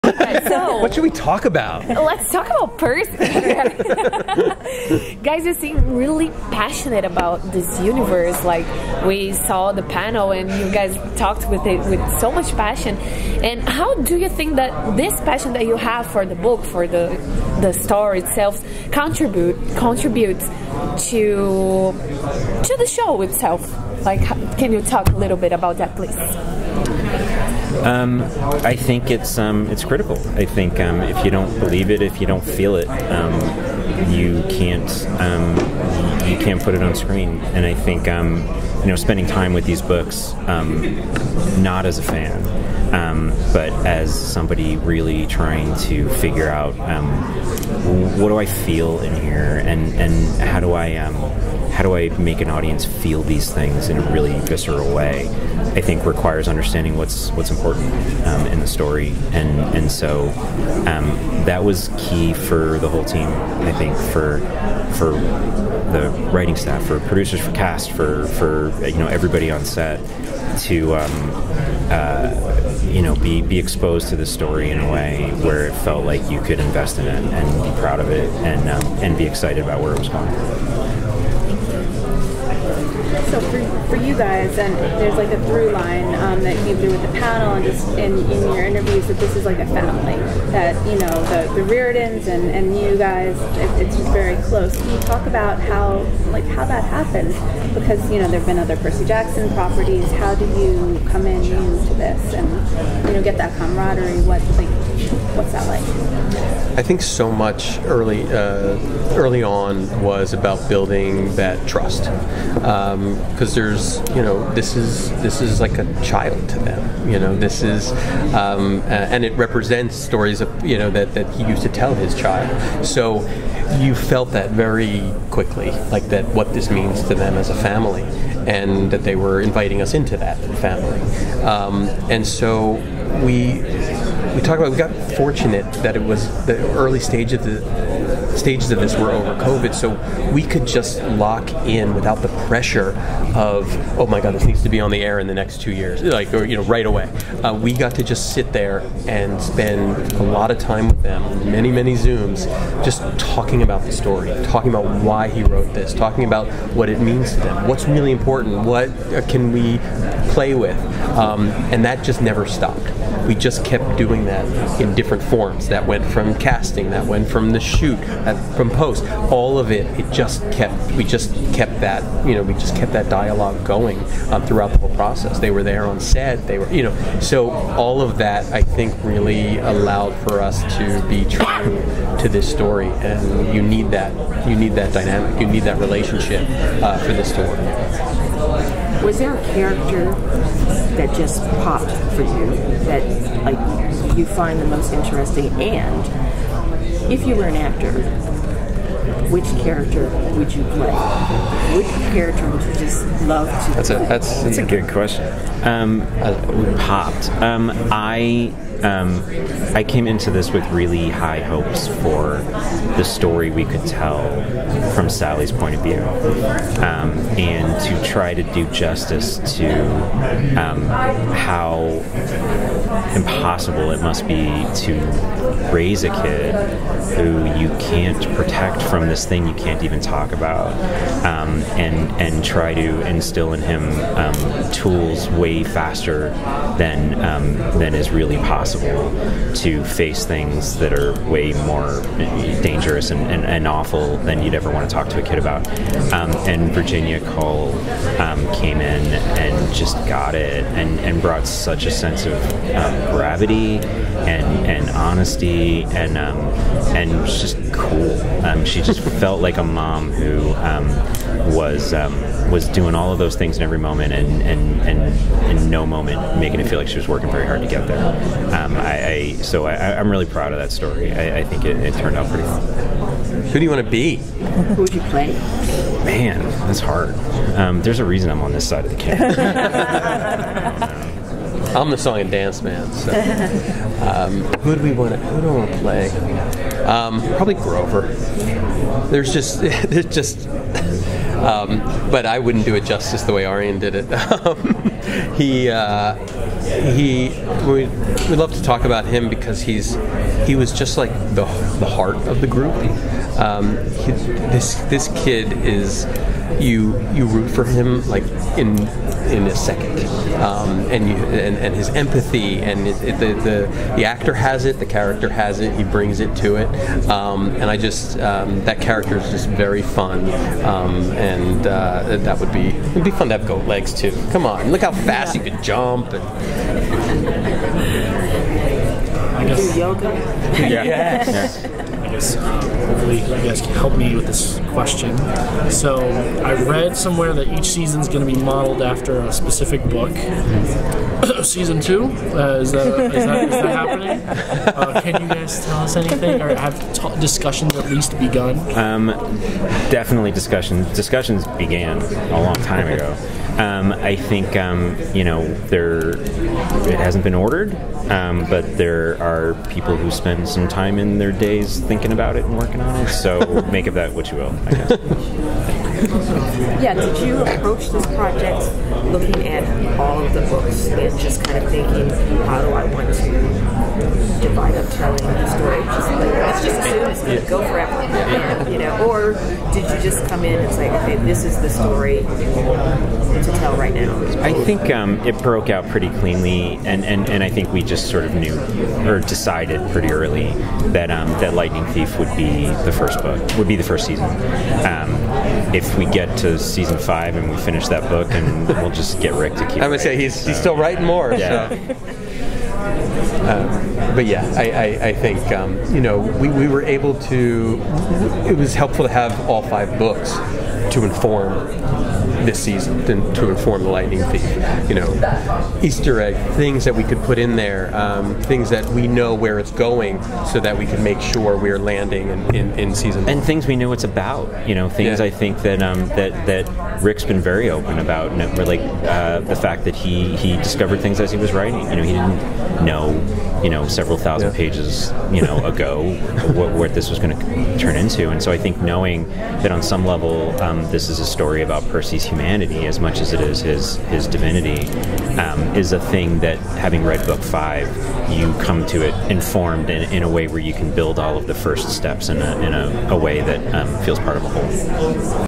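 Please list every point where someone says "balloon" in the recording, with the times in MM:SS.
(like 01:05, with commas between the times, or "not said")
not said.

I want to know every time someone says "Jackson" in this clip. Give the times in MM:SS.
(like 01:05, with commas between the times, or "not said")
01:39.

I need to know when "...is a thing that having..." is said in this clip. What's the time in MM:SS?
07:25.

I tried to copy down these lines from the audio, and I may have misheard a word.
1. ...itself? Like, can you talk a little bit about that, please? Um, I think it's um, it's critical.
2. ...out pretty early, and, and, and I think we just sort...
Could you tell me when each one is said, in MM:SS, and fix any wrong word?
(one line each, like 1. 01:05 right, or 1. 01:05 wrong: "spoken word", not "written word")
1. 00:23 right
2. 06:25 wrong: "cleanly", not "early".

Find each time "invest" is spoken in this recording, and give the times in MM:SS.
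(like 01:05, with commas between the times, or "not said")
01:16.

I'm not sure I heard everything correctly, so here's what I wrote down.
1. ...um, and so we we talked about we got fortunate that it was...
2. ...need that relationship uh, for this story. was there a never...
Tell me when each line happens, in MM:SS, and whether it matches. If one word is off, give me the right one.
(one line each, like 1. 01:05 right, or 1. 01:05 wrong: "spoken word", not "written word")
1. 02:11 right
2. 03:05 wrong: "character", not "never".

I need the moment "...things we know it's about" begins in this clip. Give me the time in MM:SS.
07:03.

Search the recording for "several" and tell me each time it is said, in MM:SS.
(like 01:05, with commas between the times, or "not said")
07:13.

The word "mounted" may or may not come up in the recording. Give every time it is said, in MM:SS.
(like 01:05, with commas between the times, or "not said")
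not said.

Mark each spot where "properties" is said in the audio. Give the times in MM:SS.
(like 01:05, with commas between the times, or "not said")
01:39.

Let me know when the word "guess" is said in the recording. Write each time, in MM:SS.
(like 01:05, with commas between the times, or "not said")
05:29, 06:04.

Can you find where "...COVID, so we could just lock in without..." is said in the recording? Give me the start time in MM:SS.
02:19.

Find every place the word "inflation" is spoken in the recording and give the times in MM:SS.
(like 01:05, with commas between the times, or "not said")
not said.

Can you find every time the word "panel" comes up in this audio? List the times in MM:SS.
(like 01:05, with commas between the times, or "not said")
00:09, 01:27.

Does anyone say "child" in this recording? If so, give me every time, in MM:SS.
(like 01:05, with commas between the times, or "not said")
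01:56, 02:02.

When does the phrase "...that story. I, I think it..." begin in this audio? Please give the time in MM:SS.
04:30.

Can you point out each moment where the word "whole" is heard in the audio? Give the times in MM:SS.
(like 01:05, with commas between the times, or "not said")
01:02, 02:54, 07:34.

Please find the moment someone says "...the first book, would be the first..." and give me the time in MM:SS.
06:32.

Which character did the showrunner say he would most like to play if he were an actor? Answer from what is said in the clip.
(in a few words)
Grover.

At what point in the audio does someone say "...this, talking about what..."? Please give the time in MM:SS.
02:35.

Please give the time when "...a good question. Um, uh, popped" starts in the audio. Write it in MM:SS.
03:24.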